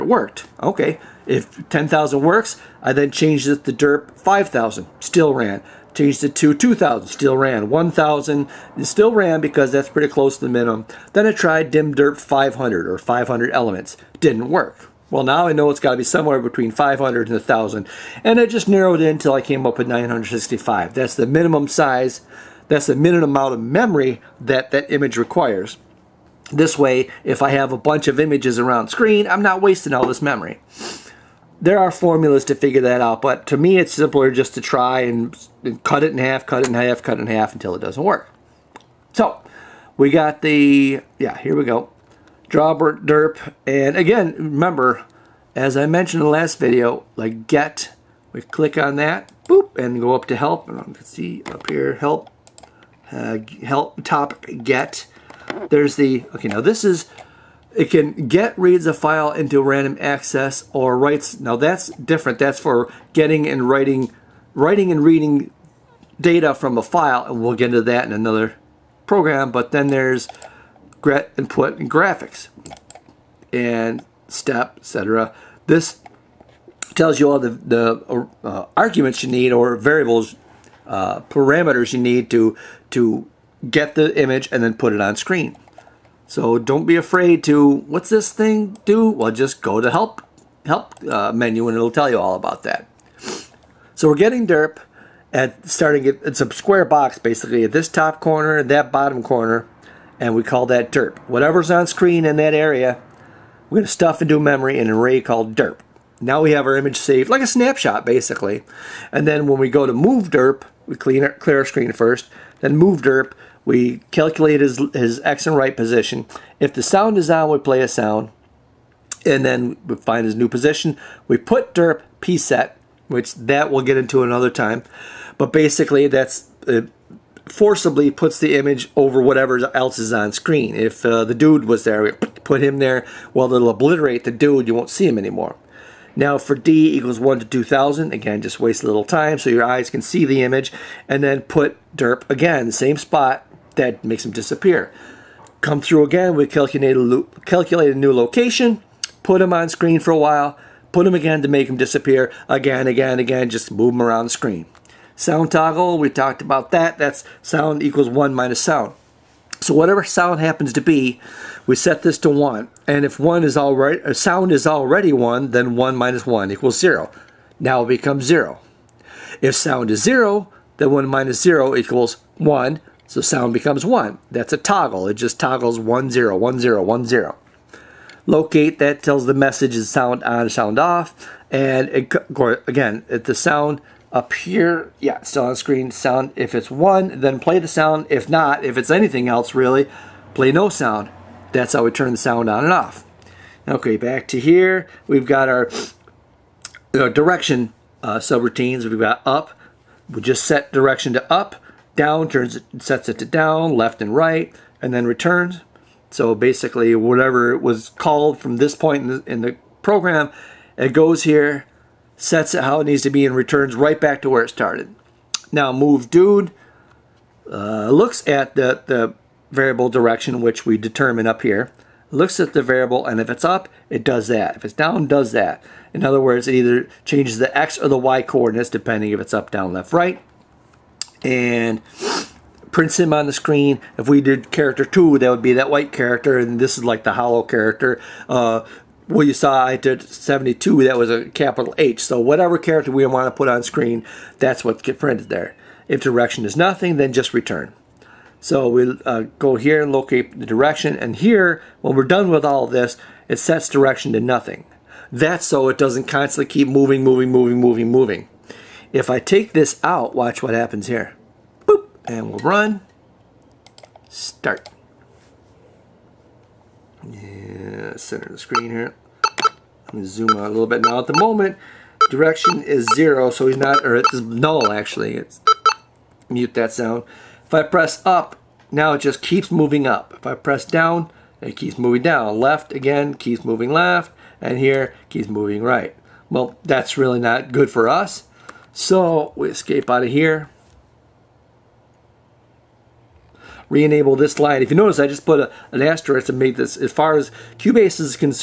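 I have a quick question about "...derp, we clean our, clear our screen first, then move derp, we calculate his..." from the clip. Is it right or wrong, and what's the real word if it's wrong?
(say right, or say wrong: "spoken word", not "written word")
right.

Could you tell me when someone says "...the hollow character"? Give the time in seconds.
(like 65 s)
237 s.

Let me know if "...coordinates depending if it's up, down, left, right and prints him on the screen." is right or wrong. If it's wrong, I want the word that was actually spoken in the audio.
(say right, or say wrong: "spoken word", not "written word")
right.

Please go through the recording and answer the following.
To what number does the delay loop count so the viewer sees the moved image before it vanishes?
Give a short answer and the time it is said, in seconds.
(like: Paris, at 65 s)
2,000, at 136 s.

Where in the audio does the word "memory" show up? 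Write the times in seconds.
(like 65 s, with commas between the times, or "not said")
23 s, 30 s, 104 s.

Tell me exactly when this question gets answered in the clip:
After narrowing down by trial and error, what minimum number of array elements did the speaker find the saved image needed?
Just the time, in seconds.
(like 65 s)
19 s.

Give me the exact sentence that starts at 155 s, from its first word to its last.
Sound toggle, we talked about that, that's sound equals 1 minus sound.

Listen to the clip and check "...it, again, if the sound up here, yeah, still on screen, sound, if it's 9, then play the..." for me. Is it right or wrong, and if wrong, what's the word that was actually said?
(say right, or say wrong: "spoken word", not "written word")
wrong: "1", not "9".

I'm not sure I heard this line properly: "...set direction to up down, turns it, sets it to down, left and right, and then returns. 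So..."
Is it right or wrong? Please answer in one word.
right.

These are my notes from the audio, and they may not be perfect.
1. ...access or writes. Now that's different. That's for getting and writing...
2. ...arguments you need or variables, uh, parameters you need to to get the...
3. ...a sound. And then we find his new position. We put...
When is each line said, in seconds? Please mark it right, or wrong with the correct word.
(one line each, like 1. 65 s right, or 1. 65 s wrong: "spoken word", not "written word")
1. 59 s right
2. 78 s right
3. 117 s right.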